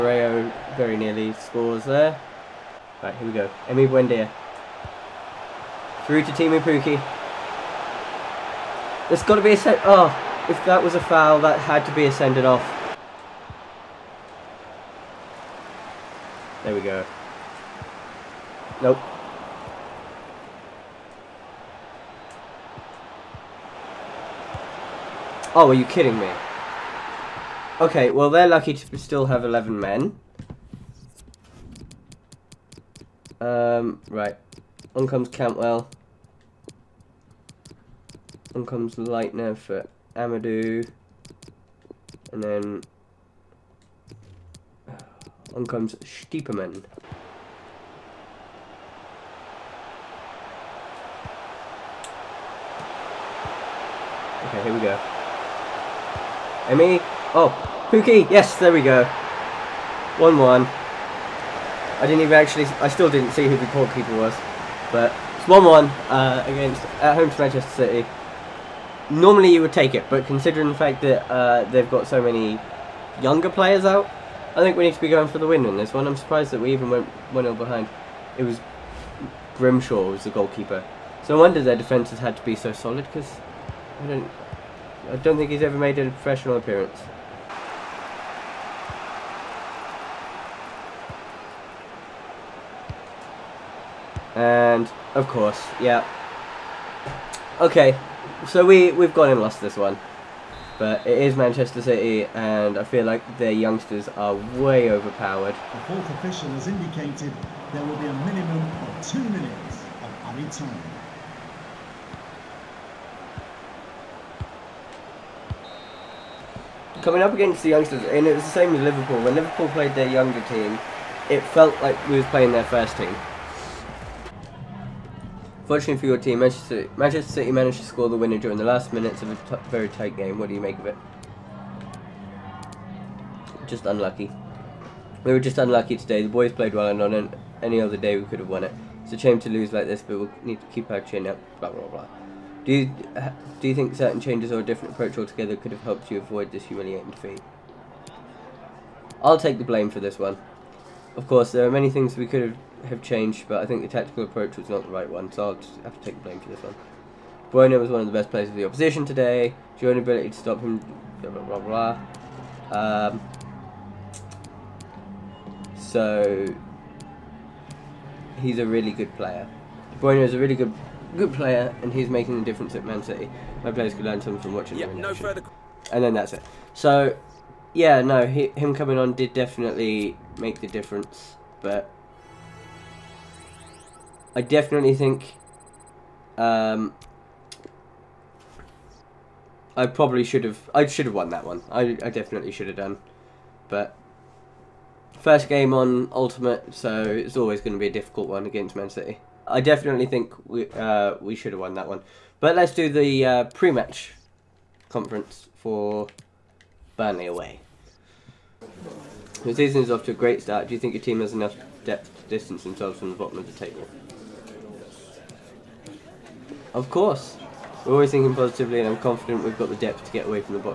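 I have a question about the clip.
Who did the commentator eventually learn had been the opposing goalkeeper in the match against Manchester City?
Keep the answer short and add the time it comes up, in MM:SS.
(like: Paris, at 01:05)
Grimshaw, at 01:19.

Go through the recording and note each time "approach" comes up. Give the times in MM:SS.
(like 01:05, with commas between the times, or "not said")
02:24, 02:34.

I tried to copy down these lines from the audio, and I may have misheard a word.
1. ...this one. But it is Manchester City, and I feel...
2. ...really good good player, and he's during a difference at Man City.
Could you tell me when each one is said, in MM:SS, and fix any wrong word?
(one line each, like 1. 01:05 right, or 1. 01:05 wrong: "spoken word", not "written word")
1. 01:39 right
2. 02:50 wrong: "making", not "during".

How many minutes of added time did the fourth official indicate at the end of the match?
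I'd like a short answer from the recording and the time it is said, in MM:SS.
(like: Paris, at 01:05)
2, at 01:49.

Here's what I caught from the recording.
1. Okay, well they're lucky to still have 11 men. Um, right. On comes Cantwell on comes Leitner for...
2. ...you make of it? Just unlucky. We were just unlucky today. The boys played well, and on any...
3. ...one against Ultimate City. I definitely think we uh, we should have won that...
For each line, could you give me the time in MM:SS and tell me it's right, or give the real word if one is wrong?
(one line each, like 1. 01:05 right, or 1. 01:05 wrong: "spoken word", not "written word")
1. 00:27 right
2. 02:10 right
3. 03:18 wrong: "Man", not "Ultimate".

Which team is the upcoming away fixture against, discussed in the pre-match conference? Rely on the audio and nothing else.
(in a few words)
Burnley.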